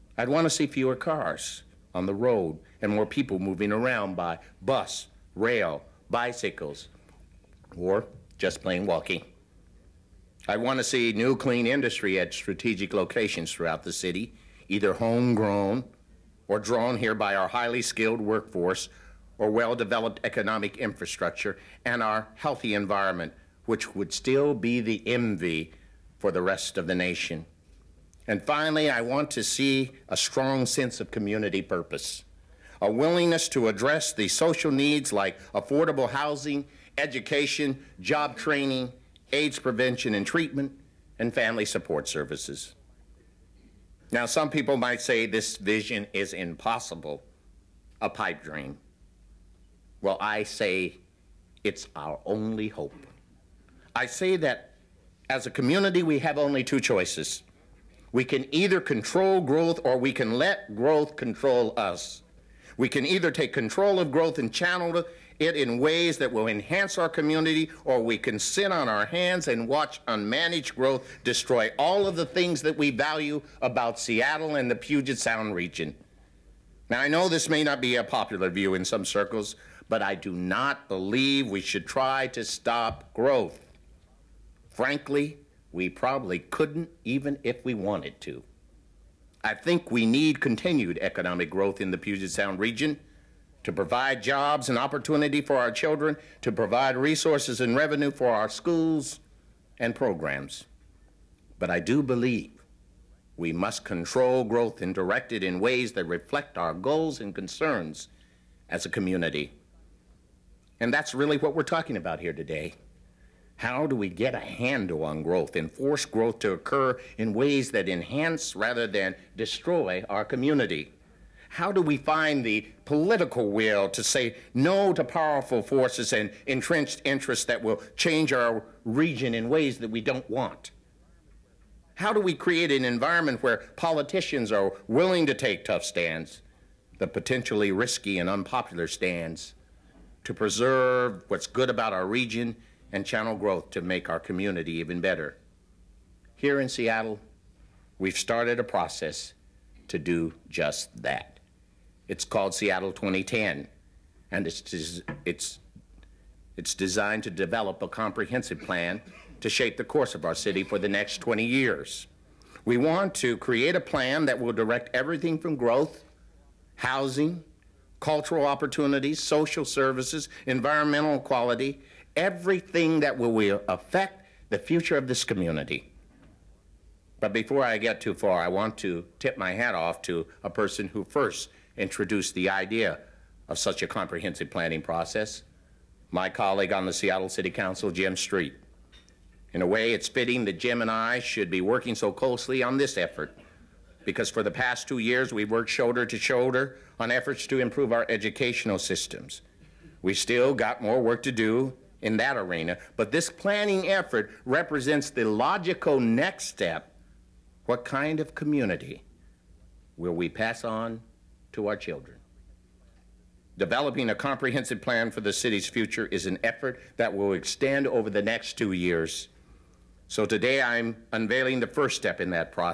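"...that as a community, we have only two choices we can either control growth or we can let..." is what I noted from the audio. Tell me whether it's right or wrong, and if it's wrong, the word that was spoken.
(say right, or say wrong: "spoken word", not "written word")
right.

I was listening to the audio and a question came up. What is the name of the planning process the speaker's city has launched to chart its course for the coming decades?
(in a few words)
Seattle 2010.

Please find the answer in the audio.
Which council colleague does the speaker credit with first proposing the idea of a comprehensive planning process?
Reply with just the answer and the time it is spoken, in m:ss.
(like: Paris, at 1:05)
Jim Street, at 3:07.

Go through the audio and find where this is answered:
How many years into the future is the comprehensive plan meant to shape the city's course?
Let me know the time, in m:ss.
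2:41.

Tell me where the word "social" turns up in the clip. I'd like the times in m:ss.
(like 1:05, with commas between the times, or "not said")
0:34, 2:49.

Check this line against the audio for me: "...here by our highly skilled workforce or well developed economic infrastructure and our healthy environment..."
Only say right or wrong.
right.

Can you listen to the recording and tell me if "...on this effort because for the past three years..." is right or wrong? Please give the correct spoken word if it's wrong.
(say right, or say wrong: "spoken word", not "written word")
wrong: "two", not "three".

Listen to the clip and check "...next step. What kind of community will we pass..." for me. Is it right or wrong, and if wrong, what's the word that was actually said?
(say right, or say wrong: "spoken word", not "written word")
right.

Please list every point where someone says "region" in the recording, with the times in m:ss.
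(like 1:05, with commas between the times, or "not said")
1:15, 1:32, 2:08, 2:22.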